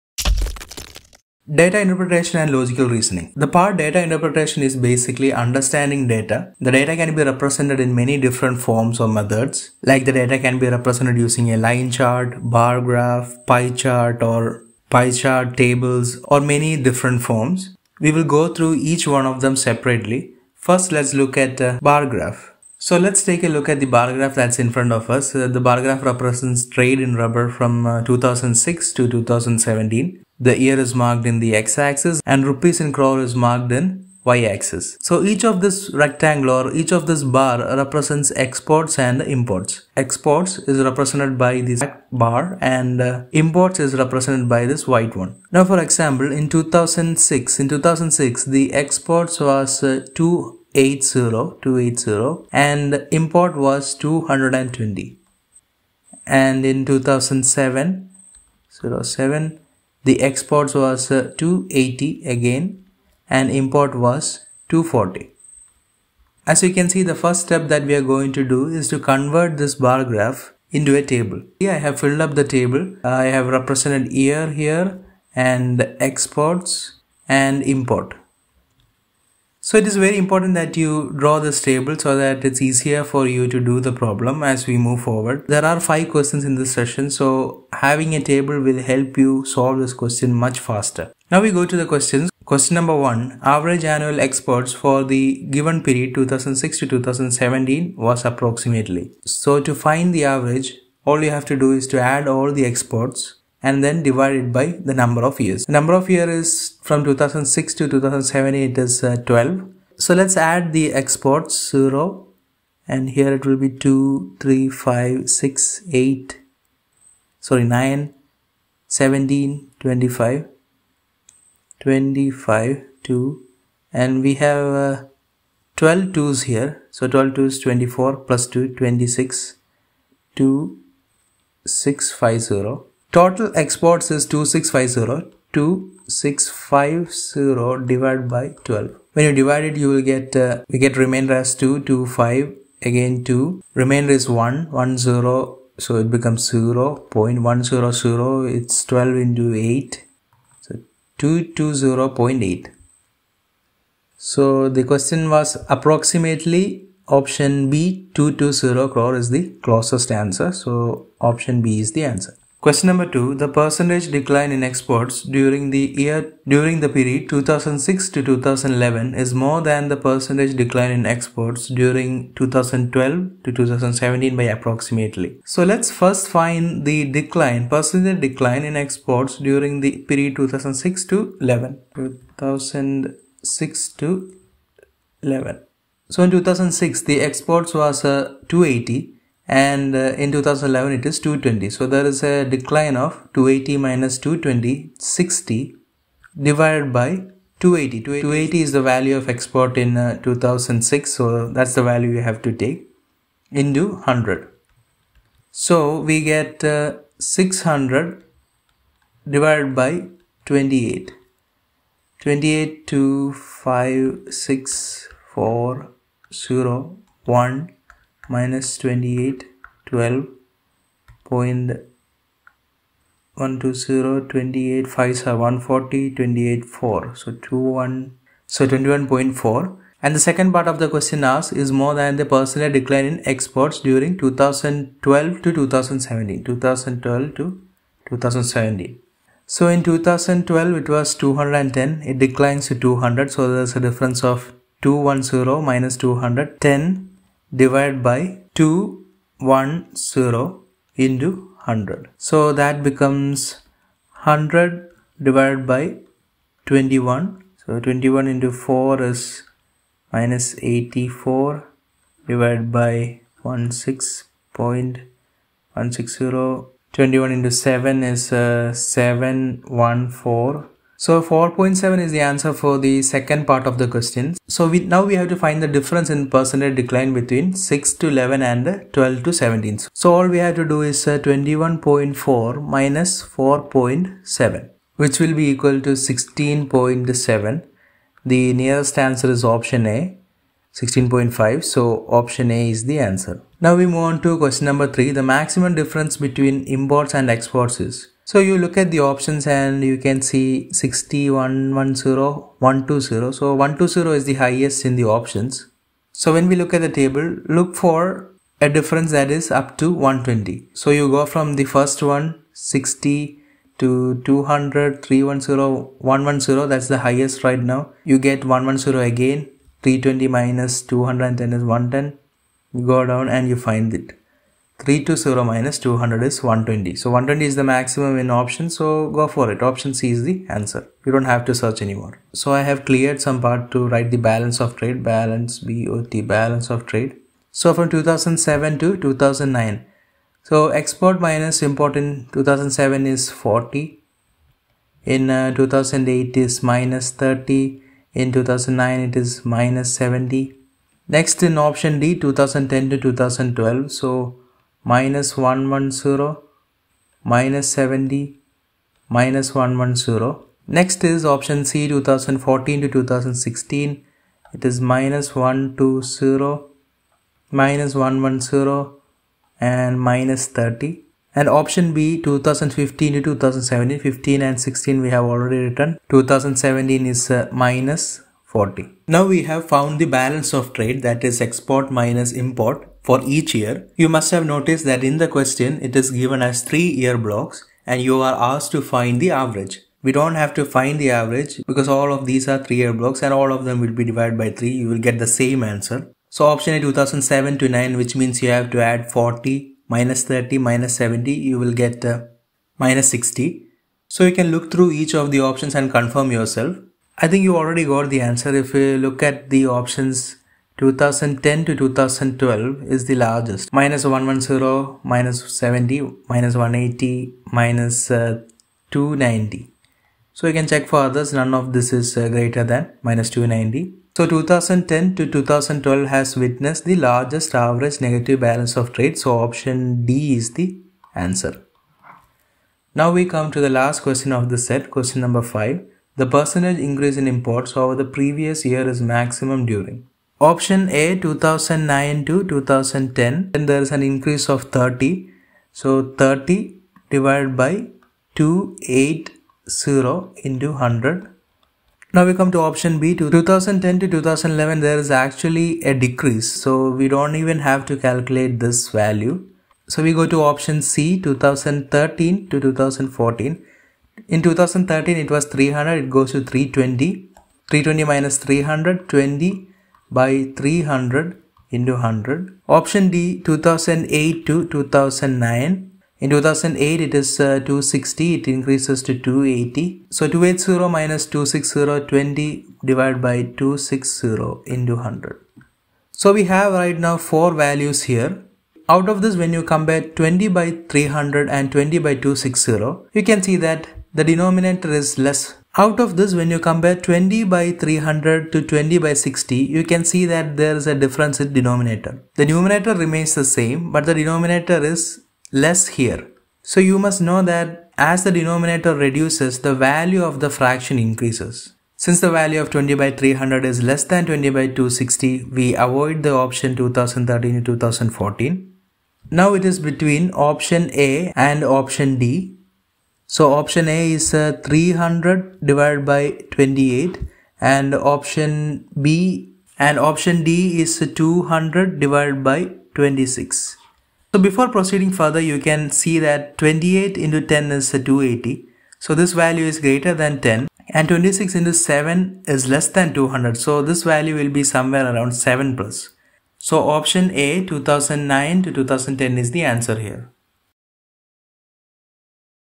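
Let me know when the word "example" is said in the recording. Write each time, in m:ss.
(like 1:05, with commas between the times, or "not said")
0:45.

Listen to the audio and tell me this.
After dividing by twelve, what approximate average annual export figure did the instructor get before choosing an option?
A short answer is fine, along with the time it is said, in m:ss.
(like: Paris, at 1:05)
220.8, at 2:31.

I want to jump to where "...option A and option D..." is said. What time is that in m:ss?
8:40.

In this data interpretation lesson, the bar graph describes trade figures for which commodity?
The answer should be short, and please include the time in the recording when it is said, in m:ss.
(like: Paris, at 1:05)
Rubber, at 0:26.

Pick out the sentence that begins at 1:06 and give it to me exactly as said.
As you can see the first step that we are going to do is to convert this bar graph into a table.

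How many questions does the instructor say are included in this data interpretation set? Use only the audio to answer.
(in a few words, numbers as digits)
5.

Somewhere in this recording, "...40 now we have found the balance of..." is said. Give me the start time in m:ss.
6:18.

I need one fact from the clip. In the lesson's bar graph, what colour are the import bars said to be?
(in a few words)
White.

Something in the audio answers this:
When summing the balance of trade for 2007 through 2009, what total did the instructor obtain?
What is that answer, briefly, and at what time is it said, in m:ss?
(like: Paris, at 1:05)
-60, at 6:42.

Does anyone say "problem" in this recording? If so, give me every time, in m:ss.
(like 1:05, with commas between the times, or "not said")
1:23.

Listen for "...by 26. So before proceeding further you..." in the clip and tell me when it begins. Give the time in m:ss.
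8:52.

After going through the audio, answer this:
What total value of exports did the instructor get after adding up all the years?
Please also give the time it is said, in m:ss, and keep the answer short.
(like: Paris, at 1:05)
2650, at 2:13.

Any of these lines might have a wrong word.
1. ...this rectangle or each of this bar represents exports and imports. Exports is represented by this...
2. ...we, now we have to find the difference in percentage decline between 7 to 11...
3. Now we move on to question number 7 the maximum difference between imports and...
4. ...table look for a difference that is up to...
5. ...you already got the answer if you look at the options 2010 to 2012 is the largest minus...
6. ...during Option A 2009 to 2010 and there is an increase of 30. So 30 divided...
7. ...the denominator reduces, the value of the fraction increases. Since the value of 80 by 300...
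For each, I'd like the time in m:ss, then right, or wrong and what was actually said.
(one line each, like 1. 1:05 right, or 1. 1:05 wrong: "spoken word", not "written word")
1. 0:35 right
2. 4:34 wrong: "6", not "7"
3. 4:53 wrong: "3", not "7"
4. 5:06 right
5. 6:47 right
6. 7:19 right
7. 8:28 wrong: "20", not "80".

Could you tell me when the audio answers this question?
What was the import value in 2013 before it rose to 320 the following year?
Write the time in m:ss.
7:44.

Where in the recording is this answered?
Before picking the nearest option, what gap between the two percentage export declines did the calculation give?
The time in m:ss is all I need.
4:45.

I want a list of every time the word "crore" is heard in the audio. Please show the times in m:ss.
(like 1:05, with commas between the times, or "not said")
0:32, 2:38.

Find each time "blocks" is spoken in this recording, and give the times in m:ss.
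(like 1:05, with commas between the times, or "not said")
6:27, 6:32.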